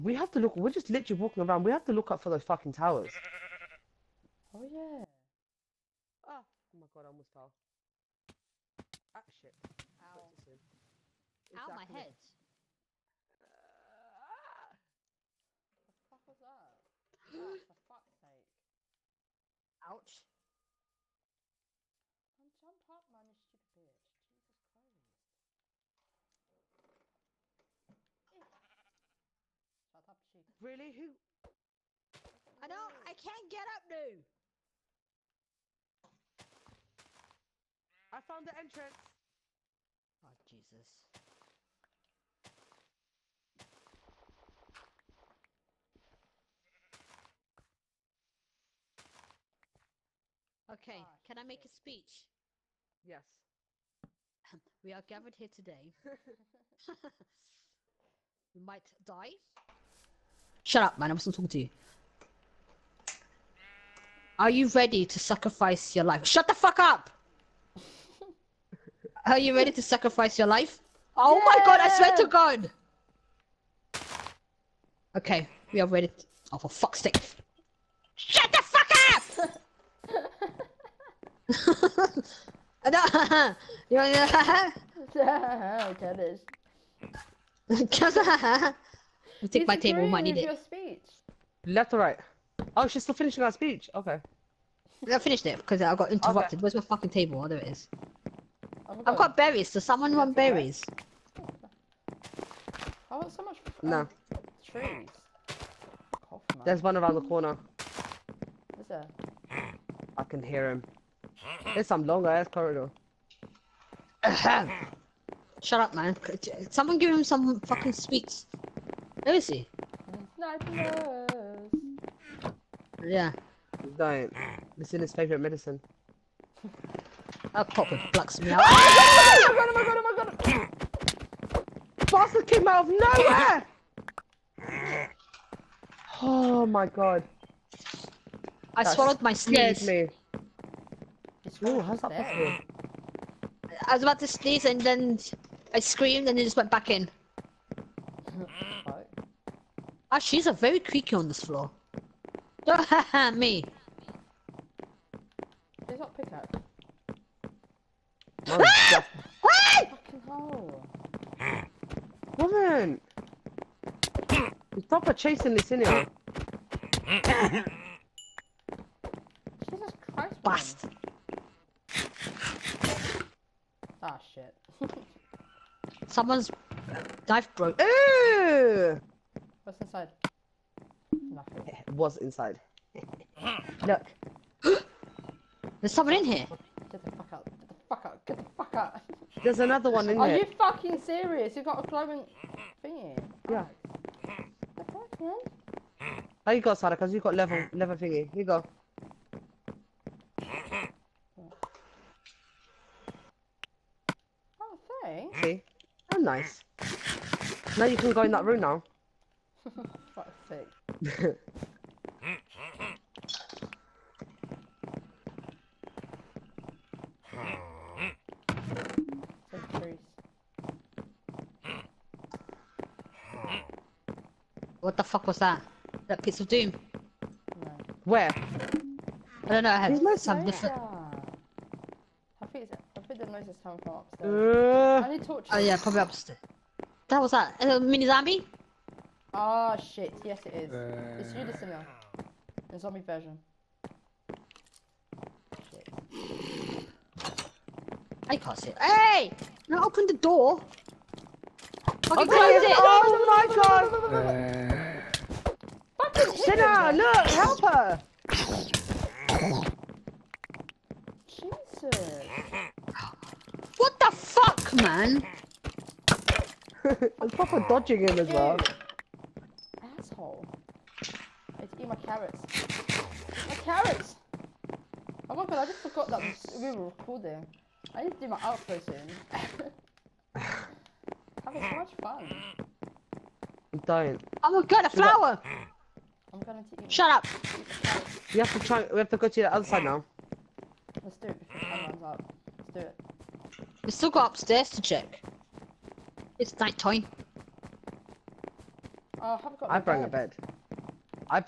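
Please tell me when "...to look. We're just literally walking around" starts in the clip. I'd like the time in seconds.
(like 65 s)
0 s.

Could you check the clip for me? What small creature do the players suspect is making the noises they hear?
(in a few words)
mini zombie.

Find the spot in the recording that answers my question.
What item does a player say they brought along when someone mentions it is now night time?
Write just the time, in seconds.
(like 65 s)
299 s.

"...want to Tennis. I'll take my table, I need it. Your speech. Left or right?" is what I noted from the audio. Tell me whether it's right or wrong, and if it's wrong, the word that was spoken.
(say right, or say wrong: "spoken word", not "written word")
right.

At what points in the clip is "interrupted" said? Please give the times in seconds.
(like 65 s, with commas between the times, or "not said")
96 s.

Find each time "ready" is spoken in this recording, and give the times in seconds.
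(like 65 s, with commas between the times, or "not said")
64 s, 69 s, 75 s.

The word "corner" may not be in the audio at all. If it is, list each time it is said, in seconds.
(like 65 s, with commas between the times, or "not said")
107 s.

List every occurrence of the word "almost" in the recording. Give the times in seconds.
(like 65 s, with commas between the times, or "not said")
7 s.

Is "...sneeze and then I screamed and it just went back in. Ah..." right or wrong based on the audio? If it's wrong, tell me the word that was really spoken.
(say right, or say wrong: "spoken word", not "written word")
right.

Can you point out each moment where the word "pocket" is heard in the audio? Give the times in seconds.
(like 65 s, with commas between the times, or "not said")
127 s.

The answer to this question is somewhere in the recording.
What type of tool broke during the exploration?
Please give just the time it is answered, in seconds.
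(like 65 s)
177 s.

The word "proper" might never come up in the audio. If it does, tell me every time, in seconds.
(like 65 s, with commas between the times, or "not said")
267 s.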